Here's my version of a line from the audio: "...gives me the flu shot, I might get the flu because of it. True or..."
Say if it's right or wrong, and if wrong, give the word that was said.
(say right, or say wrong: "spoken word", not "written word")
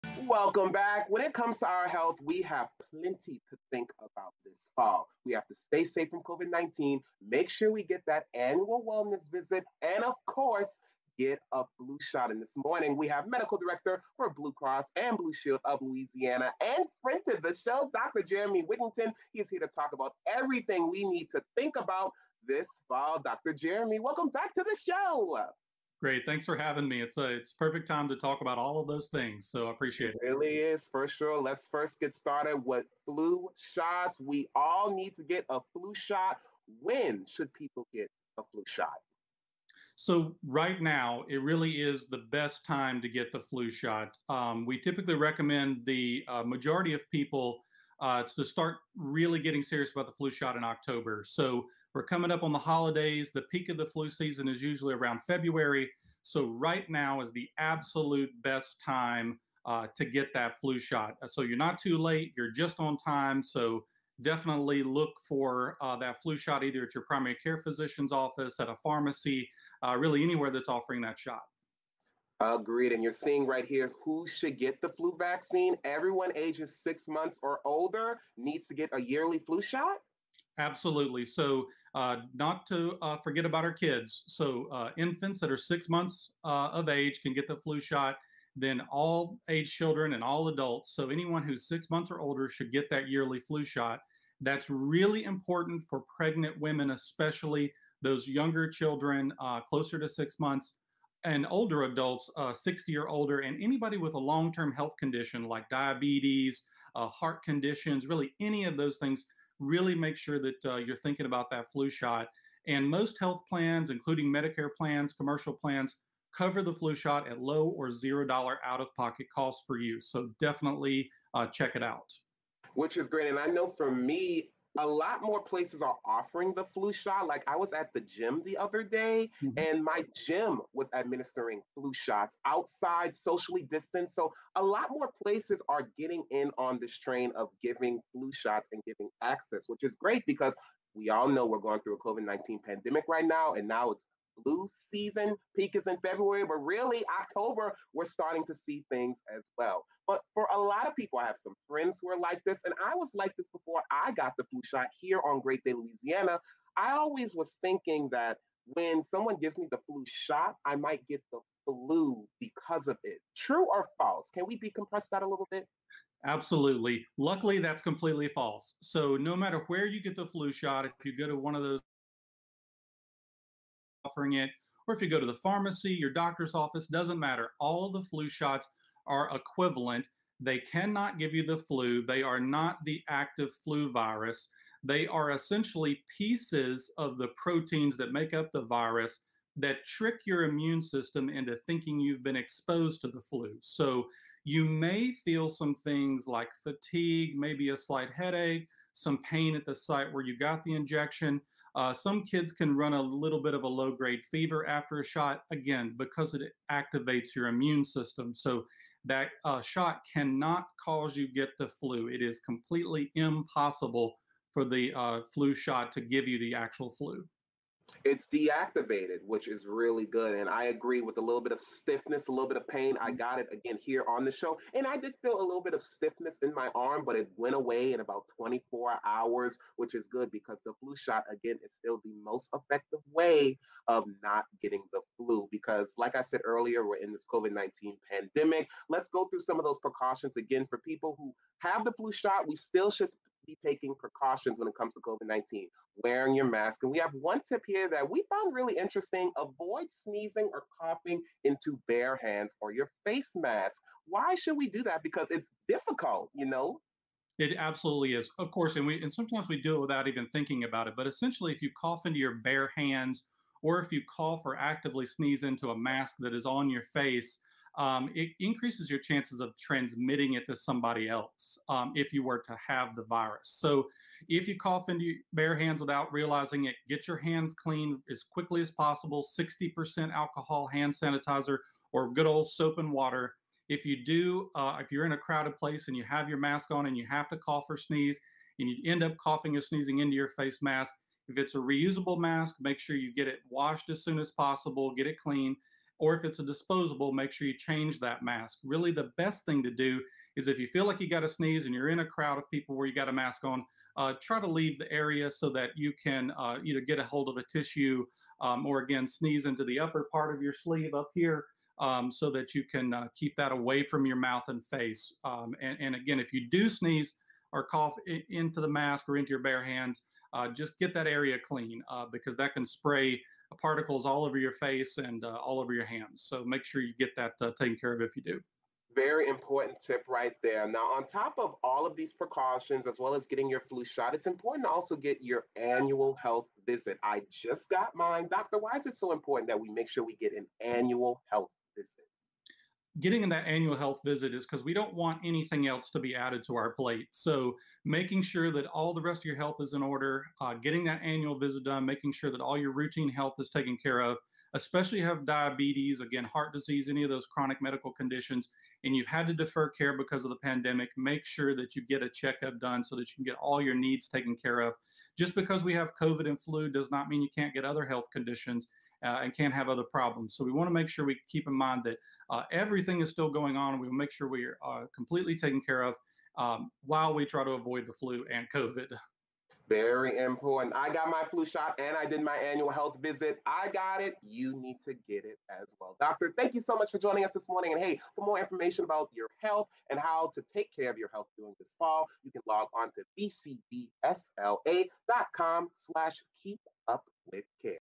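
right.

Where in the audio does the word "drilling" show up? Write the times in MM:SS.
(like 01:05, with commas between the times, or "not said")
not said.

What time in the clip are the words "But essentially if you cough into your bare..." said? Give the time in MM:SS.
04:20.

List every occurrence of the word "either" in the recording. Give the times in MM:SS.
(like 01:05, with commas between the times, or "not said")
01:06, 05:06.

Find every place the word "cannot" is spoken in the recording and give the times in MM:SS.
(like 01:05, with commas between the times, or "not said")
03:00, 03:30.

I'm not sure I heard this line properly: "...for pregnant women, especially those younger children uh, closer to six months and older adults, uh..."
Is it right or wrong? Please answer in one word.
right.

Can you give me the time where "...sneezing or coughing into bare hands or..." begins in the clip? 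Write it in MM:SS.
04:09.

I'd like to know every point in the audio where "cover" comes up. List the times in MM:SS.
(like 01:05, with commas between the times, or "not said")
01:56.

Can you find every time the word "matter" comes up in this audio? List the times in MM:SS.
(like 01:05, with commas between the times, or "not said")
02:49, 02:57.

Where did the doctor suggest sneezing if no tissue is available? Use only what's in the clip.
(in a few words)
upper part of your sleeve.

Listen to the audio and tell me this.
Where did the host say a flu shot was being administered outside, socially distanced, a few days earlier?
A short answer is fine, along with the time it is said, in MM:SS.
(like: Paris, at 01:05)
at the gym, at 02:09.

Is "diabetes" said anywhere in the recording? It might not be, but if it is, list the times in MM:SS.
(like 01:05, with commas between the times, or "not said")
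01:45, 05:55.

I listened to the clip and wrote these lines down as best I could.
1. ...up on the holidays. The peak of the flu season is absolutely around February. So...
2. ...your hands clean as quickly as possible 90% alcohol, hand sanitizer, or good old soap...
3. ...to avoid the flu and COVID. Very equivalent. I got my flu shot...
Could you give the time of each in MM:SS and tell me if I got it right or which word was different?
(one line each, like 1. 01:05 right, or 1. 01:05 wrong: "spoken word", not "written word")
1. 00:52 wrong: "usually", not "absolutely"
2. 04:37 wrong: "60", not "90"
3. 06:17 wrong: "important", not "equivalent".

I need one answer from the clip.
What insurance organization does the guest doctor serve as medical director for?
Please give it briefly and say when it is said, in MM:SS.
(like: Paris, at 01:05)
Blue Cross and Blue Shield of Louisiana, at 00:14.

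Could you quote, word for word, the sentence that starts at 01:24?
So, uh, infants that are six months uh, of age can get the flu shot.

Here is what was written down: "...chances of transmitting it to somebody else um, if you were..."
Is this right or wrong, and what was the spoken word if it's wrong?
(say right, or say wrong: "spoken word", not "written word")
right.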